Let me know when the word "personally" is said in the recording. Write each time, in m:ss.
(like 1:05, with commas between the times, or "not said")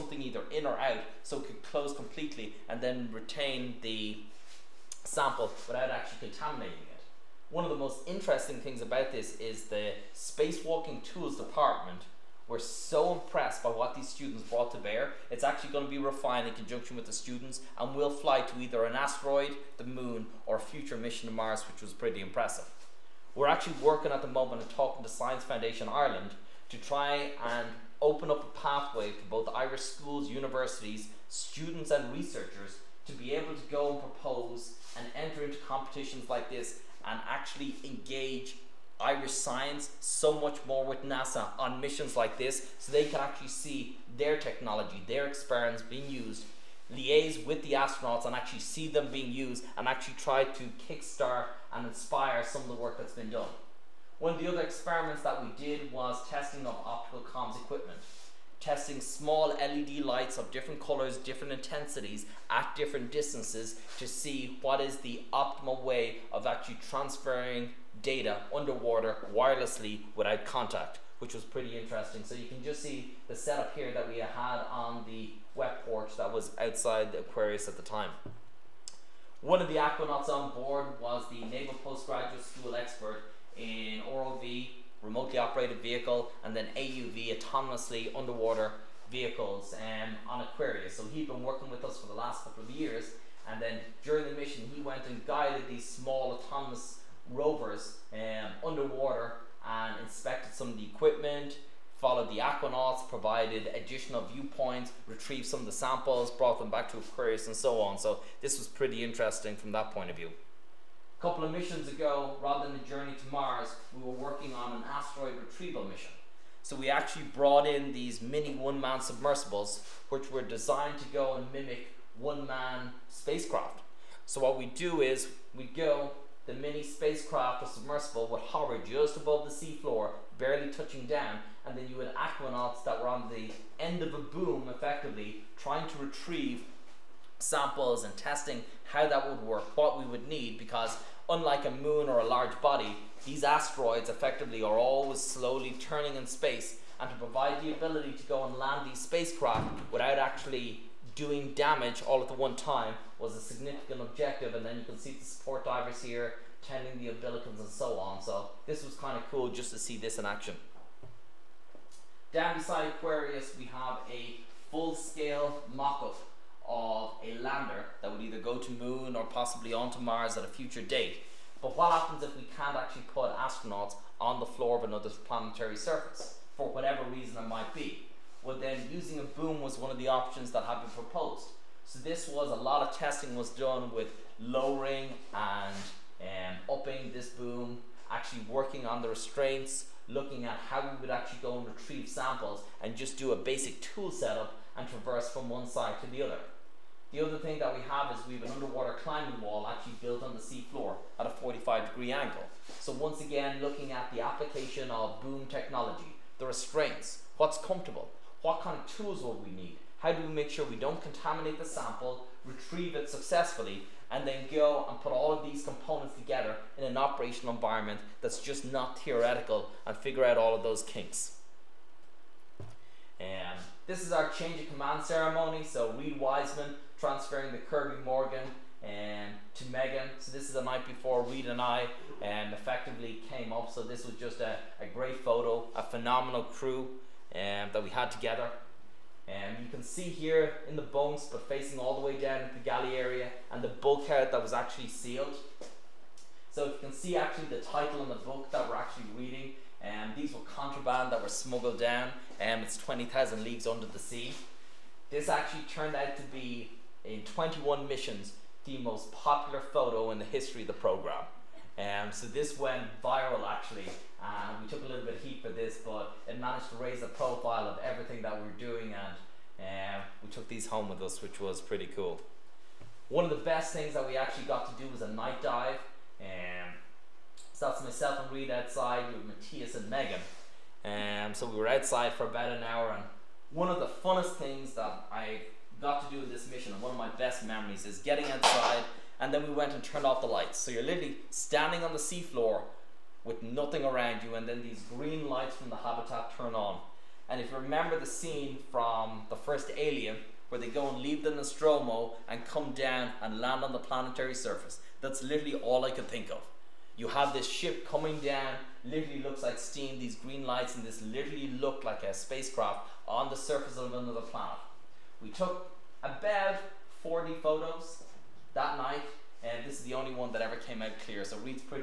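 not said.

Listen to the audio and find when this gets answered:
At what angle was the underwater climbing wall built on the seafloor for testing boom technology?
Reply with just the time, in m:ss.
3:21.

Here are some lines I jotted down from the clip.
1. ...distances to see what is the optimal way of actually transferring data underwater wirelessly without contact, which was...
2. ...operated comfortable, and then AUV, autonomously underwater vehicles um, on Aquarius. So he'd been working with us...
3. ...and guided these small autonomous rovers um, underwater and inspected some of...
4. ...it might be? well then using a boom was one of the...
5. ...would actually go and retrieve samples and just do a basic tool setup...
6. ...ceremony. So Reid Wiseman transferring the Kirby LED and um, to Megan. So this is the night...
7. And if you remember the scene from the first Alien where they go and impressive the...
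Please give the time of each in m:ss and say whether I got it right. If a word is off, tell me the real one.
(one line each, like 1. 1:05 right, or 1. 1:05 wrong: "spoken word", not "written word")
1. 1:03 right
2. 1:25 wrong: "vehicle", not "comfortable"
3. 1:35 right
4. 2:57 right
5. 3:11 right
6. 3:45 wrong: "Morgan", not "LED"
7. 4:57 wrong: "leave", not "impressive".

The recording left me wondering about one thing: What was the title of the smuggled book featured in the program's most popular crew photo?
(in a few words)
20,000 Leagues Under the Sea.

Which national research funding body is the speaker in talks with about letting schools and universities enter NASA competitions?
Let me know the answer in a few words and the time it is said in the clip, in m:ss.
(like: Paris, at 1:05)
Science Foundation Ireland, at 0:25.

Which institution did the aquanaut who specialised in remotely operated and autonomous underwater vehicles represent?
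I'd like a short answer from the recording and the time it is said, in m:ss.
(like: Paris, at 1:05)
Naval Postgraduate School, at 1:21.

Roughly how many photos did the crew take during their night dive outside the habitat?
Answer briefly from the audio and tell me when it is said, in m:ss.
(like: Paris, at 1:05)
40, at 5:17.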